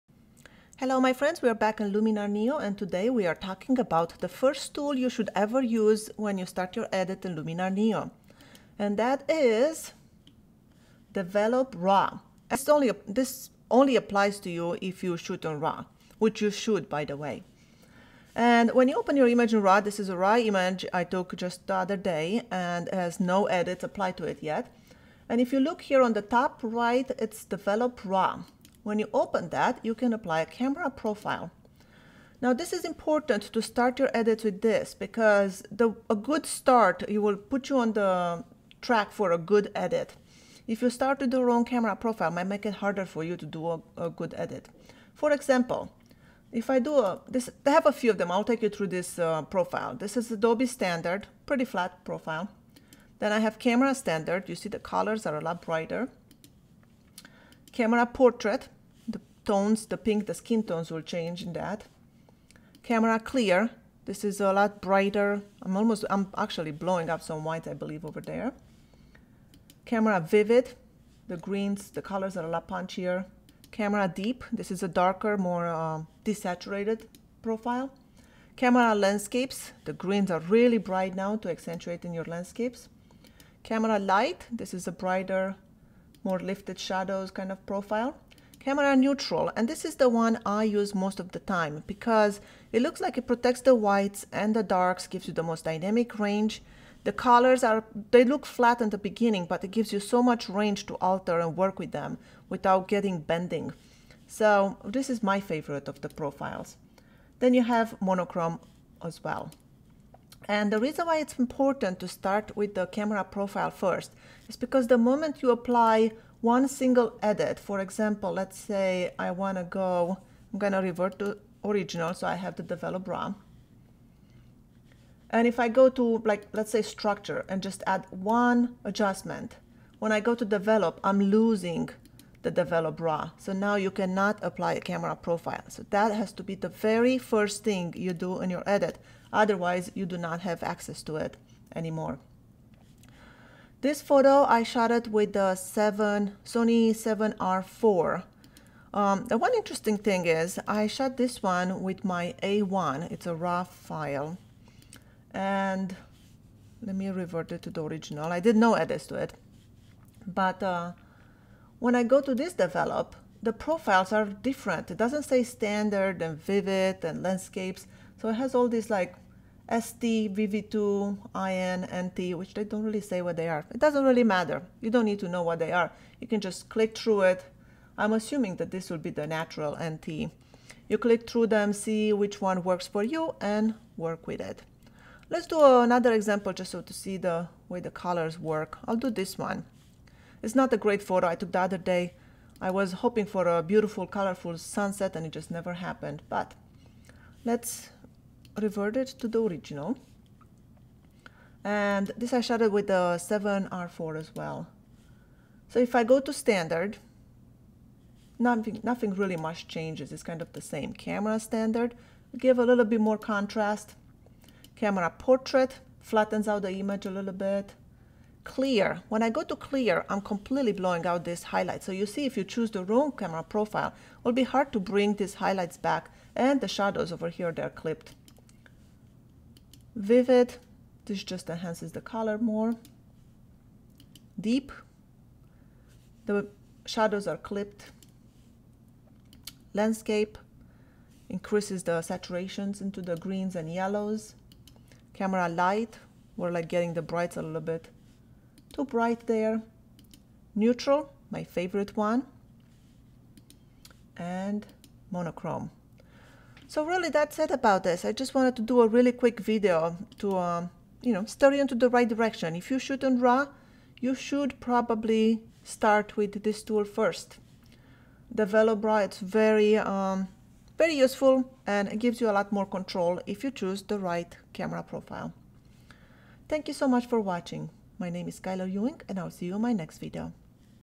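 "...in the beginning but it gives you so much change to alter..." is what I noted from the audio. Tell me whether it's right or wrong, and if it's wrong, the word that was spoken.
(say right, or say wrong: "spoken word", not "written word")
wrong: "range", not "change".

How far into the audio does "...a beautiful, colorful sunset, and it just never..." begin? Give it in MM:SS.
03:13.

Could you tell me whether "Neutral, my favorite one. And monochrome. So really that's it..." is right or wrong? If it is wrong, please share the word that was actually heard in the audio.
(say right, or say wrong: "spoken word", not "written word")
right.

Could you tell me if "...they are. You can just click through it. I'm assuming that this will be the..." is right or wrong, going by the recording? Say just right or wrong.
right.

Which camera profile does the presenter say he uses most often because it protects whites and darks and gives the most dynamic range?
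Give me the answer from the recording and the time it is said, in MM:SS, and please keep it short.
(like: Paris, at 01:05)
Camera Neutral, at 01:28.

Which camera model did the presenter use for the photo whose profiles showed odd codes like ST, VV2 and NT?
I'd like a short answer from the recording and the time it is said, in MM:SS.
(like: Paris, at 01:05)
A1, at 02:32.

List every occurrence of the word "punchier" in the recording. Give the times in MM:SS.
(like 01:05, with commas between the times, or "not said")
01:12.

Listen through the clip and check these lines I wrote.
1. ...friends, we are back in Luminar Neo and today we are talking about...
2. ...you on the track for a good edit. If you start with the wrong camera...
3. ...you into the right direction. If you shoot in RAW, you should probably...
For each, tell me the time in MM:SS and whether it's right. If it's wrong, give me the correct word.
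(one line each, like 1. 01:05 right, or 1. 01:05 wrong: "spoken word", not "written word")
1. 00:01 right
2. 00:37 right
3. 04:21 right.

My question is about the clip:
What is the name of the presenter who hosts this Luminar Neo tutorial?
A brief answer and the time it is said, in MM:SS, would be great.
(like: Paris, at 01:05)
Skyler Ewing, at 04:38.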